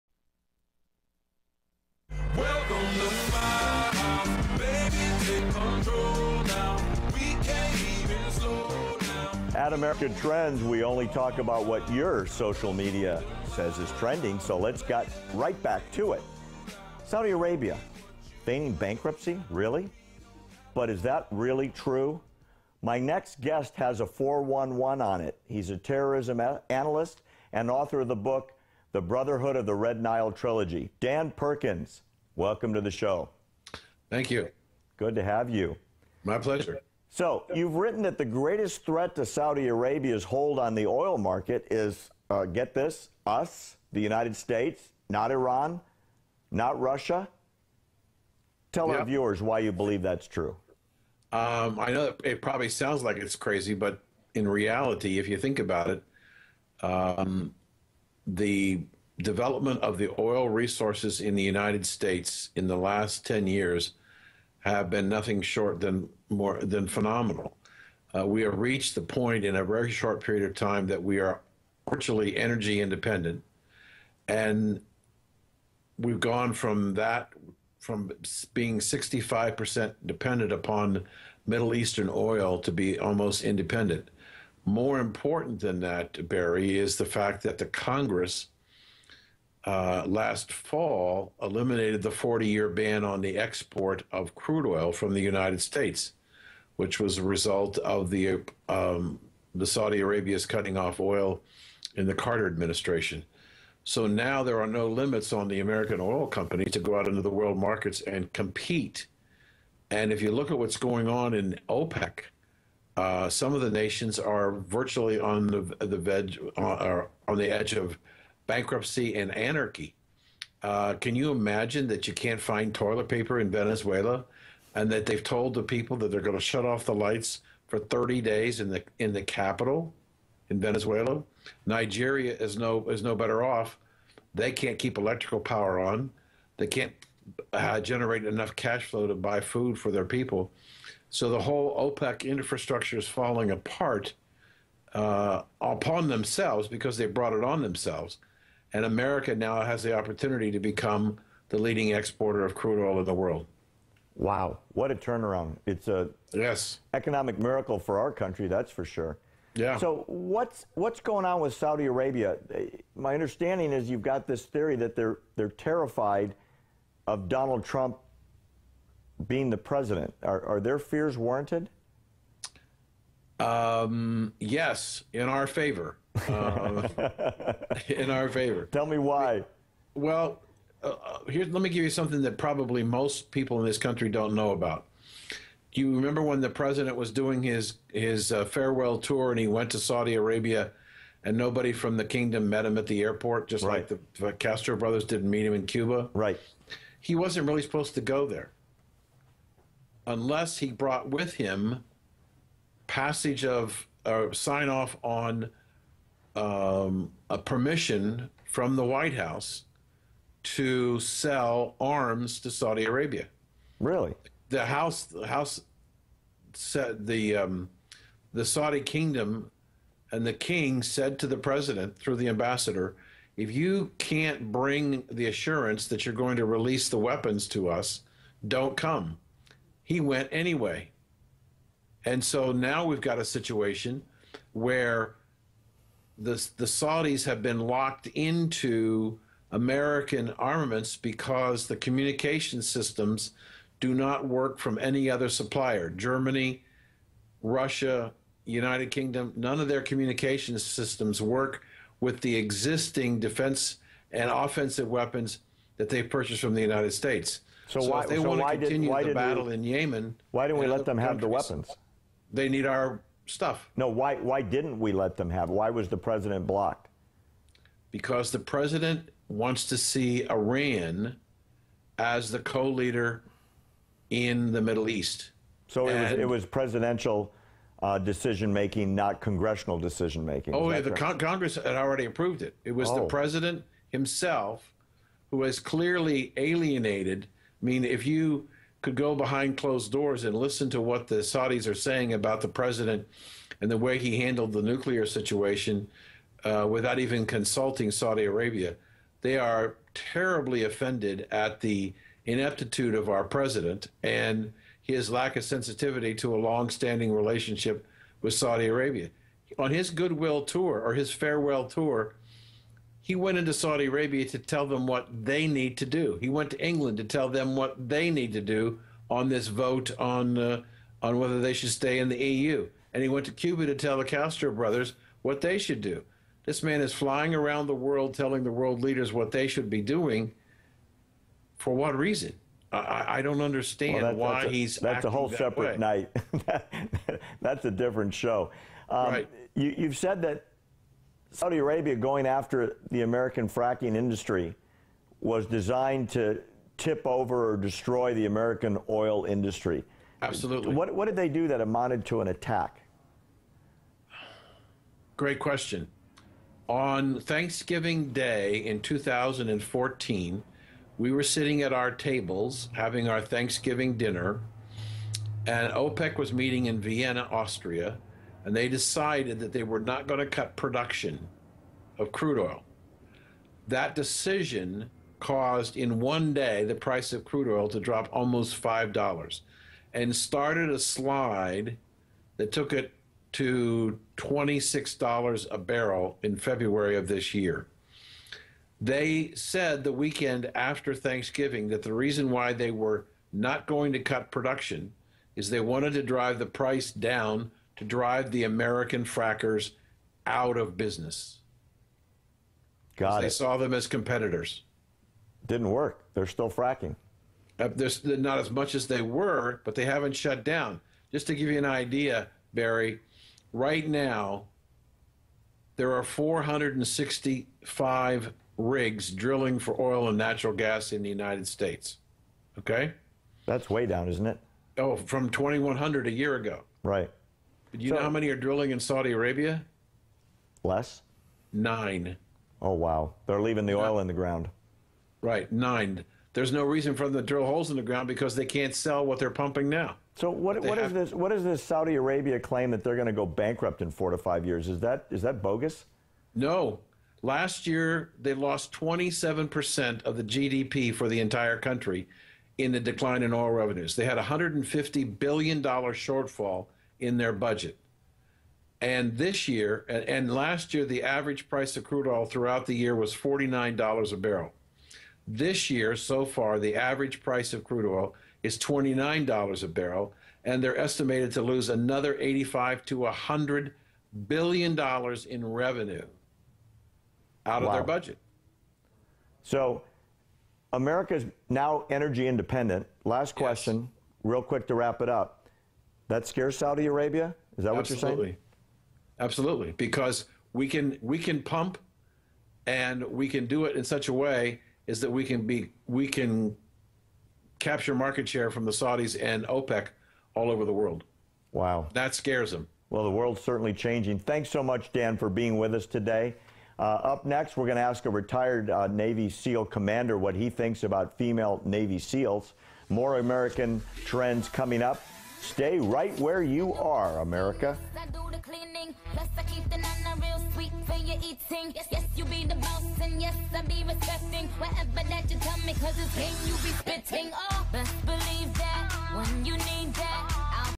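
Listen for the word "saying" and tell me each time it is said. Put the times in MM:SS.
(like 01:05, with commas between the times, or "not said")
04:51, 08:08.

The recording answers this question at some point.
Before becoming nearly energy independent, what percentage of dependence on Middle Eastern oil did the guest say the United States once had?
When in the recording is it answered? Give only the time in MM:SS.
01:18.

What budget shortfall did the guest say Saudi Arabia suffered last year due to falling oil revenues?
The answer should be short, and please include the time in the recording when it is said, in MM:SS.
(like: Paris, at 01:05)
$150 billion, at 07:34.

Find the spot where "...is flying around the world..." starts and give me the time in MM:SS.
05:26.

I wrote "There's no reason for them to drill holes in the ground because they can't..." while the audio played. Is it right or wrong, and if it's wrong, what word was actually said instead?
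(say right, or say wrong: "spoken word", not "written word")
right.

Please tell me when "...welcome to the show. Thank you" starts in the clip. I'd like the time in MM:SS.
00:32.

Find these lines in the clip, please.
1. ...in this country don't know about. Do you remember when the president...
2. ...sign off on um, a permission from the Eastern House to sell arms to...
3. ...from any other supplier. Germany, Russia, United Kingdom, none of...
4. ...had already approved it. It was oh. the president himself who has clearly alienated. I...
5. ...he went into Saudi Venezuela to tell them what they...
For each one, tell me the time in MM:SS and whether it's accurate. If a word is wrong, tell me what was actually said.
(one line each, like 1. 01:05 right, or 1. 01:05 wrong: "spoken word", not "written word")
1. 03:03 right
2. 03:24 wrong: "White", not "Eastern"
3. 04:04 right
4. 04:41 right
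5. 05:13 wrong: "Arabia", not "Venezuela".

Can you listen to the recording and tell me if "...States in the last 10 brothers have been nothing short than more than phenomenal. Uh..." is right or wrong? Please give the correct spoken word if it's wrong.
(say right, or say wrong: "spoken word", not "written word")
wrong: "years", not "brothers".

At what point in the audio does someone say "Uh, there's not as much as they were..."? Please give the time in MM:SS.
06:47.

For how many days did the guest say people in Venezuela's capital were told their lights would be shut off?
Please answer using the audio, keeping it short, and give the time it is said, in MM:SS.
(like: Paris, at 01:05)
30 days, at 02:07.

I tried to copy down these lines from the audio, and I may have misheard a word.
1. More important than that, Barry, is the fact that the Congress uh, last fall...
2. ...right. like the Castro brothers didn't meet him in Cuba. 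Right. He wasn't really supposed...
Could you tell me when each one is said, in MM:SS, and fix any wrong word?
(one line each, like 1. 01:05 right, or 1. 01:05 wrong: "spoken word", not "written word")
1. 01:24 right
2. 03:13 right.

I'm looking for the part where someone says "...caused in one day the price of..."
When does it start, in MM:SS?
06:15.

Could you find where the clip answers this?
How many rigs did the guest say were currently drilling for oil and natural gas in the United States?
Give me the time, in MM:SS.
06:56.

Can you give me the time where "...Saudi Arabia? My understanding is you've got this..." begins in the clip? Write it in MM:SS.
02:41.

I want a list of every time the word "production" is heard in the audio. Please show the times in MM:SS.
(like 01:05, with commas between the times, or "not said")
06:10, 06:34.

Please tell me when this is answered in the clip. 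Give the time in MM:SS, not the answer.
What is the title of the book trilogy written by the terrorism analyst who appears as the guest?
00:28.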